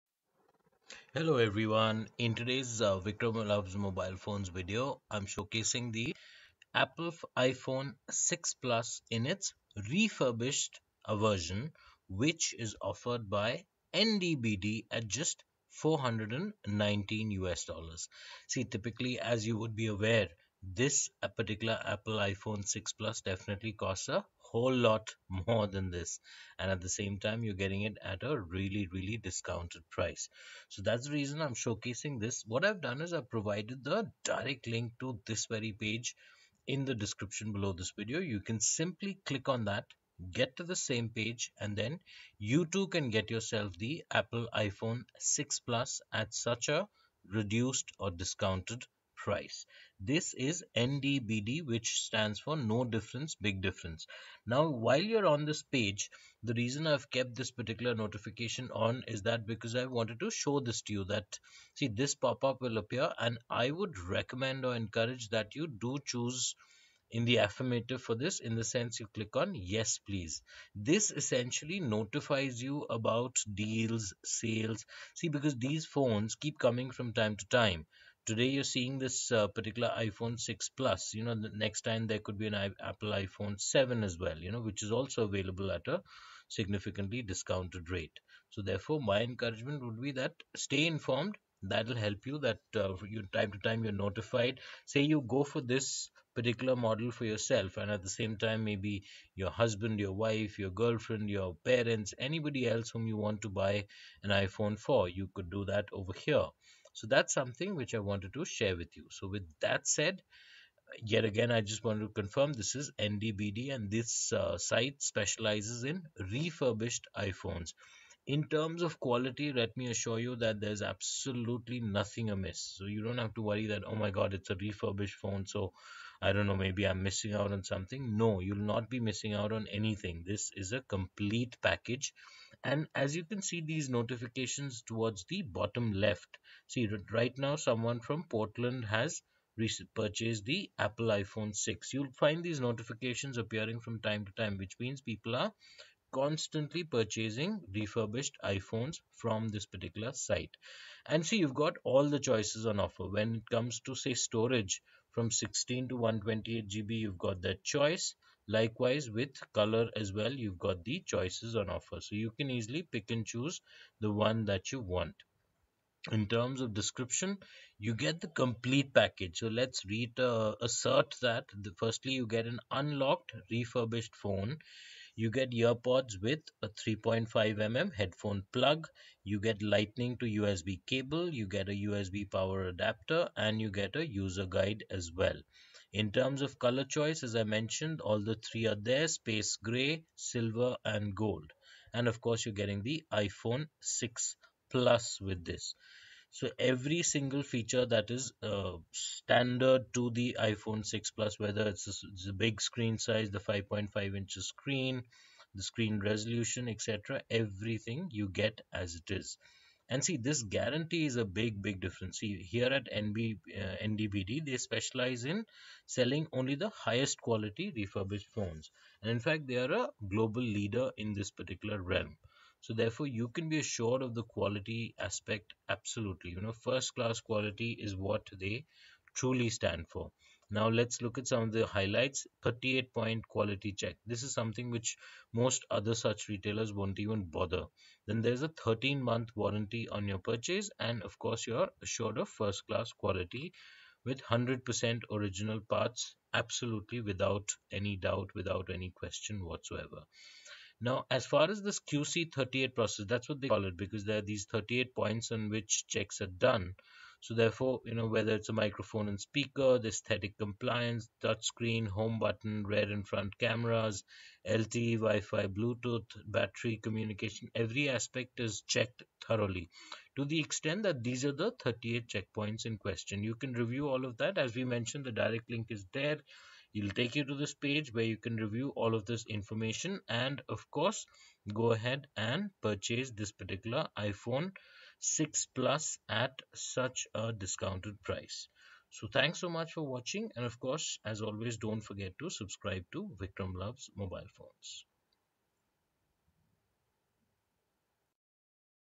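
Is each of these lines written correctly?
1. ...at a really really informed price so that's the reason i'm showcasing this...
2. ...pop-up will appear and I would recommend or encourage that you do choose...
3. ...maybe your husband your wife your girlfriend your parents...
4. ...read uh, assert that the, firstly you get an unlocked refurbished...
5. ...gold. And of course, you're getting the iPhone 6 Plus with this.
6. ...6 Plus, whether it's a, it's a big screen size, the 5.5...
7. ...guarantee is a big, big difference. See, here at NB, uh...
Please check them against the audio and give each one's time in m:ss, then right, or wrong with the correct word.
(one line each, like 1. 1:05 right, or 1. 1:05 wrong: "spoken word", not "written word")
1. 0:28 wrong: "discounted", not "informed"
2. 1:02 right
3. 1:38 right
4. 2:49 right
5. 3:11 right
6. 3:20 right
7. 3:30 right.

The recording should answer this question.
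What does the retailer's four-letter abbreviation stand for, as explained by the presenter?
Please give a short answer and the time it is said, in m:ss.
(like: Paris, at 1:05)
No difference, big difference, at 0:52.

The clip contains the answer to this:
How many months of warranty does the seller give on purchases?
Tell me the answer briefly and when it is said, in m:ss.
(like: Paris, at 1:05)
13, at 3:58.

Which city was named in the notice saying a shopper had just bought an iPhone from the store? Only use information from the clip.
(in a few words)
Portland.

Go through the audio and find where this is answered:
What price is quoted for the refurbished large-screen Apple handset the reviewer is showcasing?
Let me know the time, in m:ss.
0:15.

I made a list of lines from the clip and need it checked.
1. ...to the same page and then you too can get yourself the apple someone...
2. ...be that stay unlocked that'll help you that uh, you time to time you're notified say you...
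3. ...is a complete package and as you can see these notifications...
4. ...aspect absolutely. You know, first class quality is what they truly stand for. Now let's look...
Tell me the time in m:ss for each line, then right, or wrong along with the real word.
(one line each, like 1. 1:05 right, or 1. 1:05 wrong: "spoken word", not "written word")
1. 0:40 wrong: "iphone", not "someone"
2. 1:29 wrong: "informed", not "unlocked"
3. 2:10 right
4. 3:44 right.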